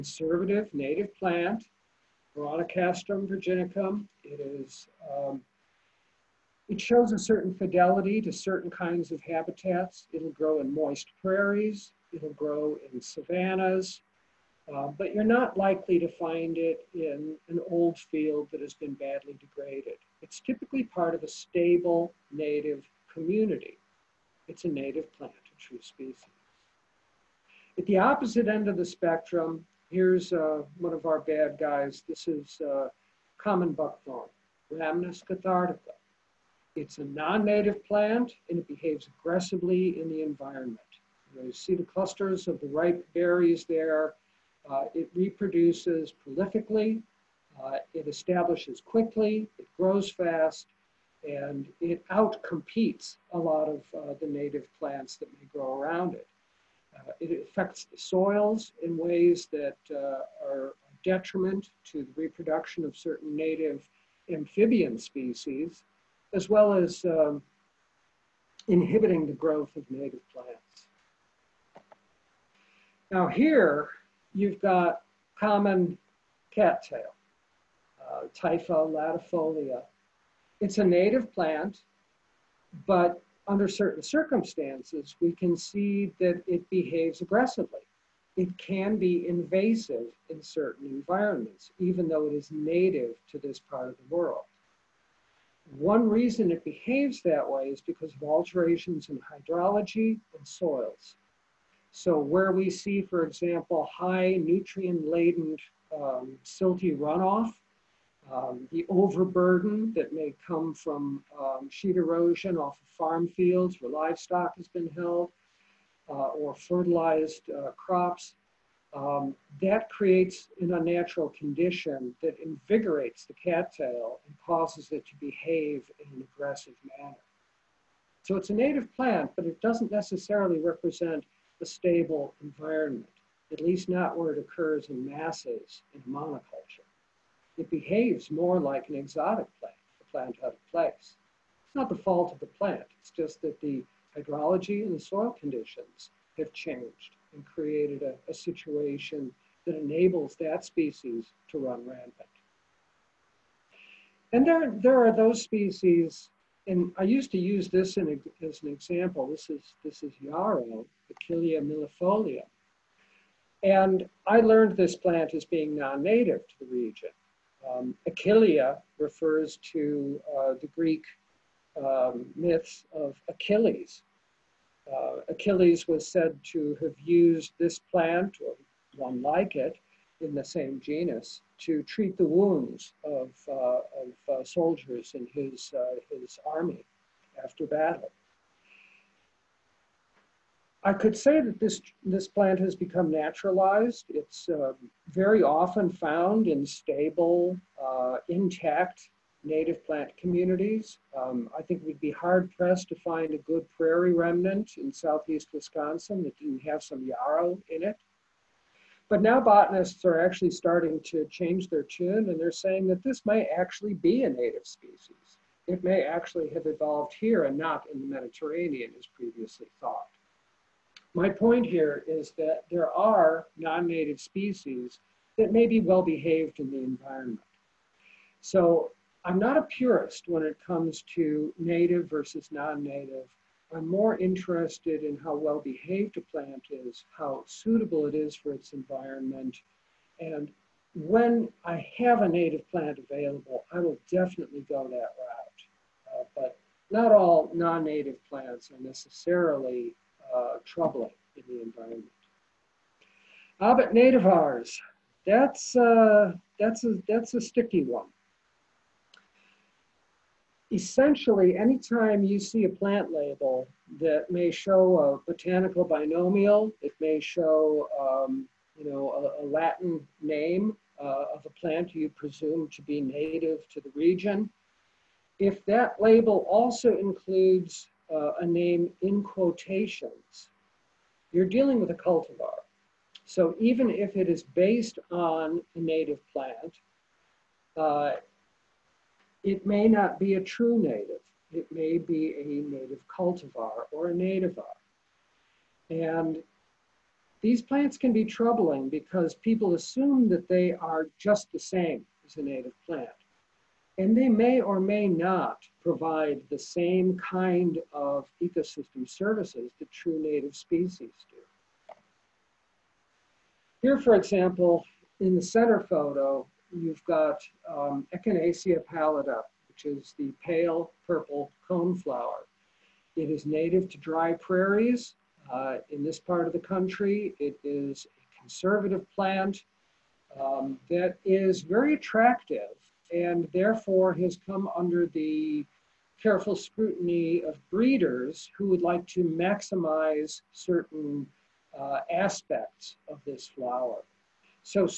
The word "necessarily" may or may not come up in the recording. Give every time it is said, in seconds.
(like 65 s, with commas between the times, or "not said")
129 s, 248 s.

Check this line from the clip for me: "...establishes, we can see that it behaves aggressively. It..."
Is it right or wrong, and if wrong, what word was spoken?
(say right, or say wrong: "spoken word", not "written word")
wrong: "circumstances", not "establishes".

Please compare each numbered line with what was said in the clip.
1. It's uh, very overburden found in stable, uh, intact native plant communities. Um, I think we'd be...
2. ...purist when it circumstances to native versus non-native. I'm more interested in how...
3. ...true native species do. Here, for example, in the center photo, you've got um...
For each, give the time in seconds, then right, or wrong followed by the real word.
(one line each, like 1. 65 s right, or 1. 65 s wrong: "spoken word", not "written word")
1. 194 s wrong: "often", not "overburden"
2. 229 s wrong: "comes", not "circumstances"
3. 309 s right.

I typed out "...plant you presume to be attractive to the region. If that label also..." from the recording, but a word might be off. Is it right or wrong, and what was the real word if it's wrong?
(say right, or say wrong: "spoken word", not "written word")
wrong: "native", not "attractive".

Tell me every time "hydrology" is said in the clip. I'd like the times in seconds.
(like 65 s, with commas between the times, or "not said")
99 s, 144 s.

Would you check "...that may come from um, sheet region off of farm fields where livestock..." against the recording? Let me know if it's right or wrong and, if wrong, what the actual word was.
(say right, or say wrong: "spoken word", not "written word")
wrong: "erosion", not "region".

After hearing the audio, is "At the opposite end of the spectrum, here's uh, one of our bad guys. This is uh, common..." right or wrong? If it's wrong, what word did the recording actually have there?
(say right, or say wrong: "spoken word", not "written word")
right.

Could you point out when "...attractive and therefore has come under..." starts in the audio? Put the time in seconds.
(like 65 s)
331 s.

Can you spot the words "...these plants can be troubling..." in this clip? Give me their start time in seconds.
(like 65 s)
297 s.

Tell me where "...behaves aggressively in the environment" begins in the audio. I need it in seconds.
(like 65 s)
38 s.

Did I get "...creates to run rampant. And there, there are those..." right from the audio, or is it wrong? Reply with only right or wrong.
wrong.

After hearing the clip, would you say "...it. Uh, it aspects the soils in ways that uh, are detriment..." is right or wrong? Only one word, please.
wrong.